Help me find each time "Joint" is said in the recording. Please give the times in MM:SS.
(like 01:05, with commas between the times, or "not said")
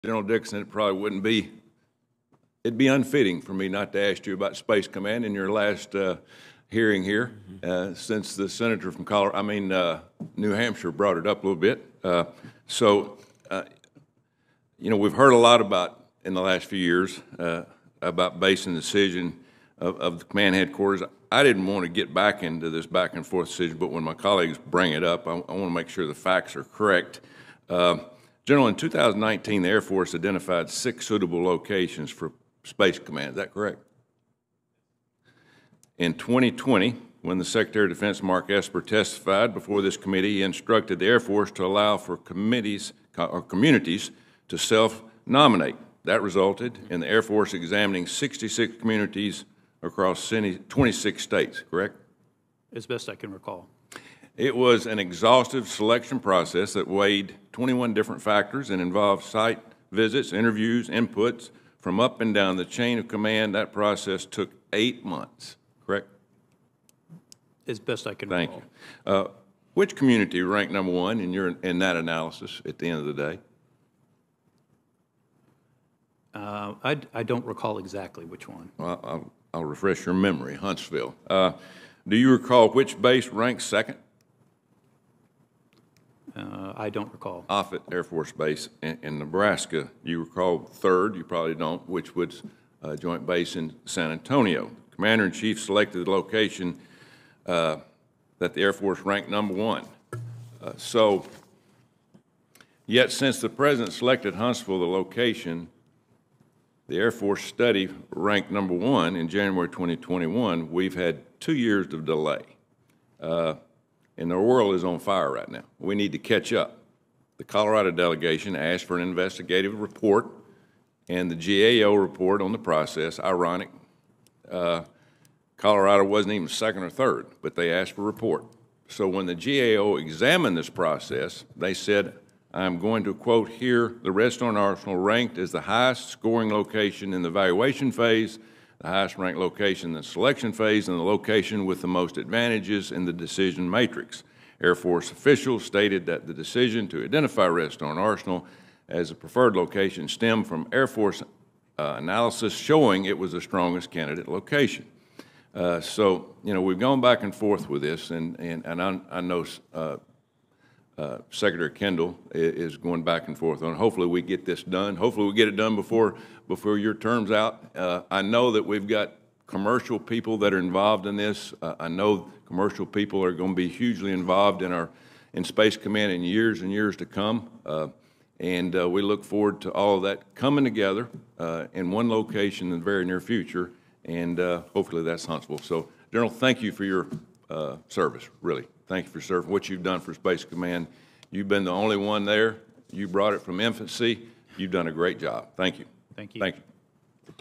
01:32.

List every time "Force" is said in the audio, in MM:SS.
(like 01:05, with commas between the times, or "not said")
00:29, 00:41, 00:47, 01:28, 01:38, 01:47, 02:24, 02:30.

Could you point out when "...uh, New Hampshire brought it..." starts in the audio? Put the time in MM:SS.
00:09.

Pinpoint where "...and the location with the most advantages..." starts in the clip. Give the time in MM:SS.
02:20.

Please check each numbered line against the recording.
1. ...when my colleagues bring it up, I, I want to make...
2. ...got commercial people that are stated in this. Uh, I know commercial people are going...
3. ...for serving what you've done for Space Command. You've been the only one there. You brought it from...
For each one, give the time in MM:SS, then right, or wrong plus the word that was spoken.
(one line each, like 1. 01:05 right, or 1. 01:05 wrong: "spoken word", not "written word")
1. 00:23 right
2. 02:48 wrong: "involved", not "stated"
3. 03:09 right.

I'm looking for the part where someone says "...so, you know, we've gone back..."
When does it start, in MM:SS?
02:35.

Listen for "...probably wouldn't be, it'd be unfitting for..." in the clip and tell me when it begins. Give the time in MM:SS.
00:00.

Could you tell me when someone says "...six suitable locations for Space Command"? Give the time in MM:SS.
00:30.